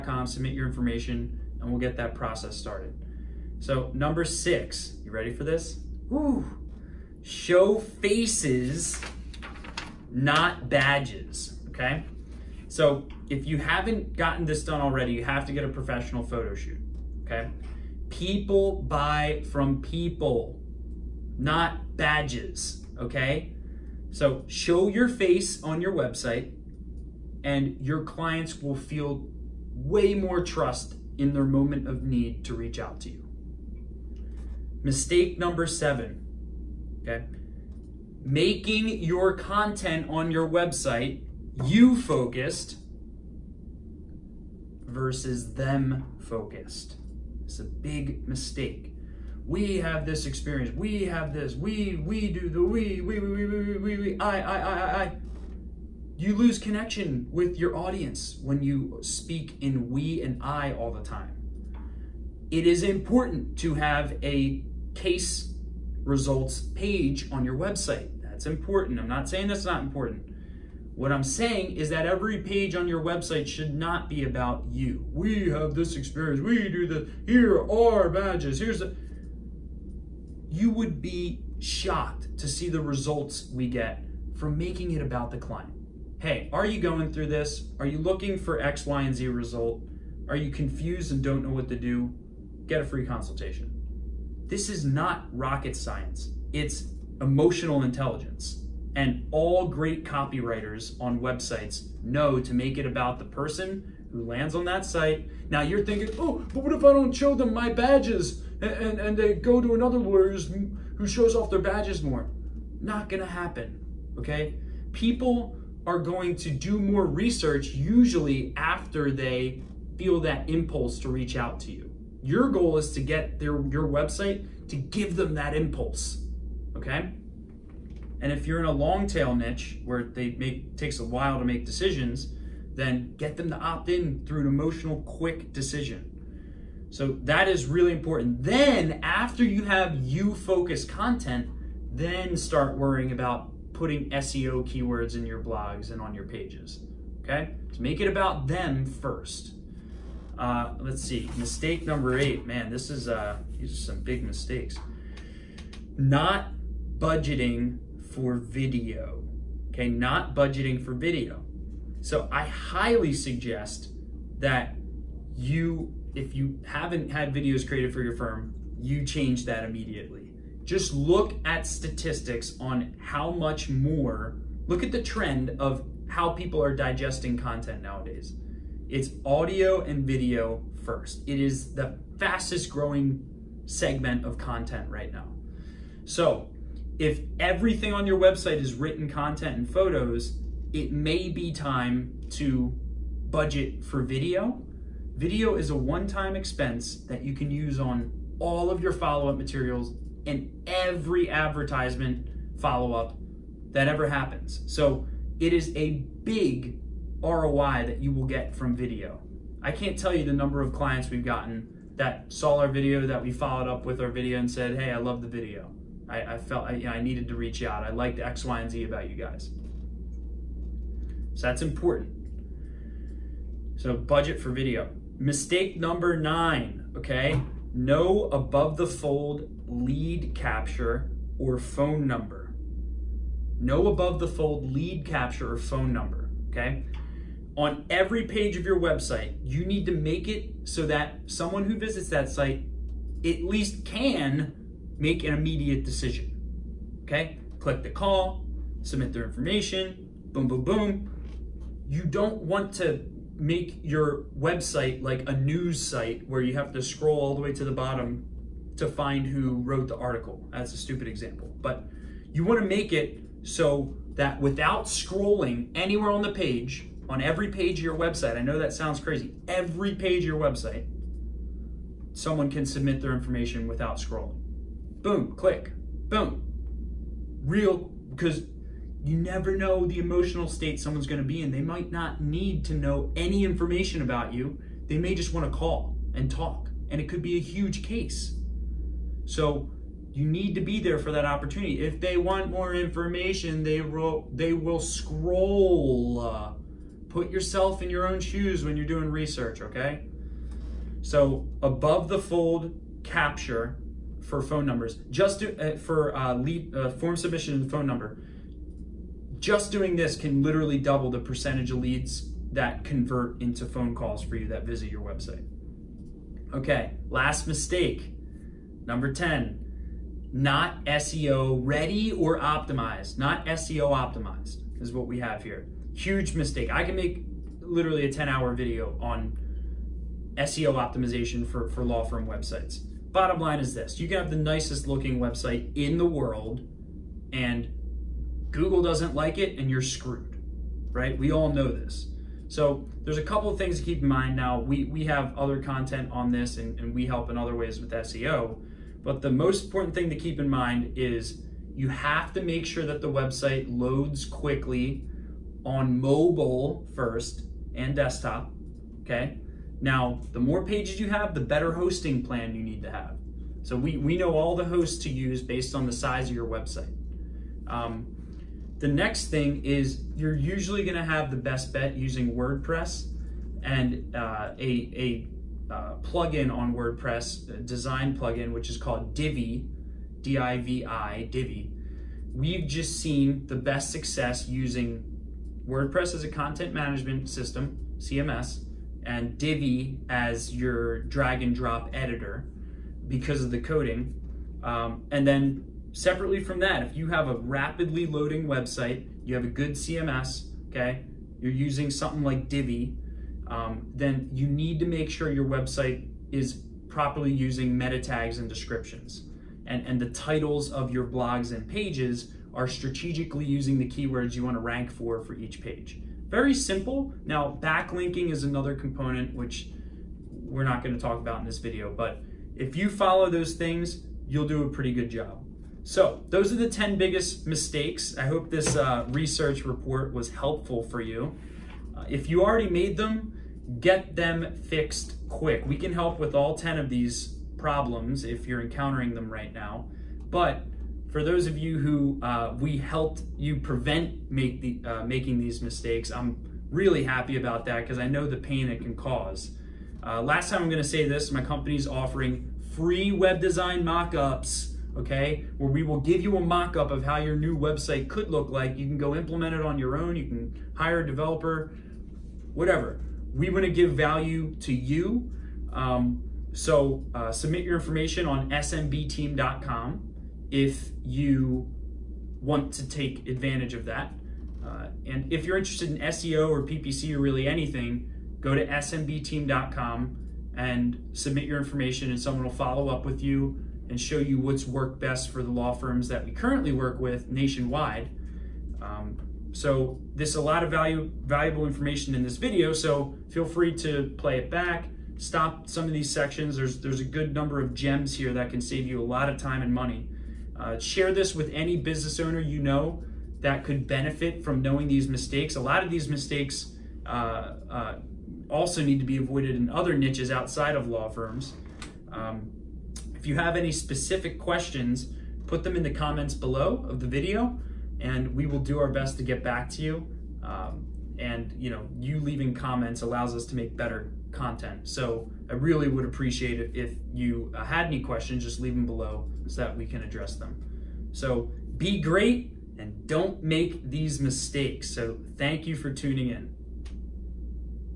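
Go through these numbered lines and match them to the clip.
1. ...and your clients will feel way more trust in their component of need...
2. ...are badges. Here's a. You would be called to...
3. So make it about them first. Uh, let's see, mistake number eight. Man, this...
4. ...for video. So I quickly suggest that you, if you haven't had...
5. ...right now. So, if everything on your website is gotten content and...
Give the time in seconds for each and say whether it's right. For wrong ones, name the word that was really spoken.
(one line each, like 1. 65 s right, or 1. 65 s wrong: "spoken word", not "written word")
1. 27 s wrong: "moment", not "component"
2. 77 s wrong: "shocked", not "called"
3. 147 s right
4. 160 s wrong: "highly", not "quickly"
5. 184 s wrong: "written", not "gotten".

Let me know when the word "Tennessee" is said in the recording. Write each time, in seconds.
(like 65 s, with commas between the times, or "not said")
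not said.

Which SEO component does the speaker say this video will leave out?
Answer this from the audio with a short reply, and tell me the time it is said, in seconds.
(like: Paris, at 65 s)
Backlinking, at 417 s.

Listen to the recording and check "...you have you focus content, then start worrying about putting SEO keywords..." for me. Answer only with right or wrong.
right.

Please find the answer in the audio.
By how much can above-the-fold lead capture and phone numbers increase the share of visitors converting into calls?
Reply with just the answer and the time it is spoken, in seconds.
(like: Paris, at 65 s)
Double, at 310 s.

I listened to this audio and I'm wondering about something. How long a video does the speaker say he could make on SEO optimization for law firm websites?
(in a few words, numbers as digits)
10 hours.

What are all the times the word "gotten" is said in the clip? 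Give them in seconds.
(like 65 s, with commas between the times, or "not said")
14 s, 211 s.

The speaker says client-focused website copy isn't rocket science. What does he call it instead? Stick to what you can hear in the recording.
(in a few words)
Emotional intelligence.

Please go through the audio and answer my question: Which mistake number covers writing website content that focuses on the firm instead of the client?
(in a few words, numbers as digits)
7.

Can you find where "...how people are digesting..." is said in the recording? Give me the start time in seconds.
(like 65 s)
176 s.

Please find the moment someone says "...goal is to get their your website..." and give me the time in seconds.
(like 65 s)
122 s.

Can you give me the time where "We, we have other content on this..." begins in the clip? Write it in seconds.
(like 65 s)
344 s.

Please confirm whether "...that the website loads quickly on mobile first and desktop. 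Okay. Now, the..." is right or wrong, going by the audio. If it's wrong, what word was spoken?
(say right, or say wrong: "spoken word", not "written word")
right.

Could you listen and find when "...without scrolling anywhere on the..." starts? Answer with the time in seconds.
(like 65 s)
264 s.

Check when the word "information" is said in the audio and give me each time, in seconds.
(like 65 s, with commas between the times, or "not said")
0 s, 249 s, 273 s, 283 s, 292 s, 467 s, 481 s, 491 s.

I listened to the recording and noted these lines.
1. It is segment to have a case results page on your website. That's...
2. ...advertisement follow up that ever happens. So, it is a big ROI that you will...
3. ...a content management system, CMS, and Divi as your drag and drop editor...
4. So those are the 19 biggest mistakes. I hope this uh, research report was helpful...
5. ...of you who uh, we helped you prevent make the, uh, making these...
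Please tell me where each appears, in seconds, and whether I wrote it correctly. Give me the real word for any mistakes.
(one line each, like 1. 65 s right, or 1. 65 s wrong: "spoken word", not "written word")
1. 62 s wrong: "important", not "segment"
2. 201 s right
3. 386 s right
4. 425 s wrong: "10", not "19"
5. 441 s right.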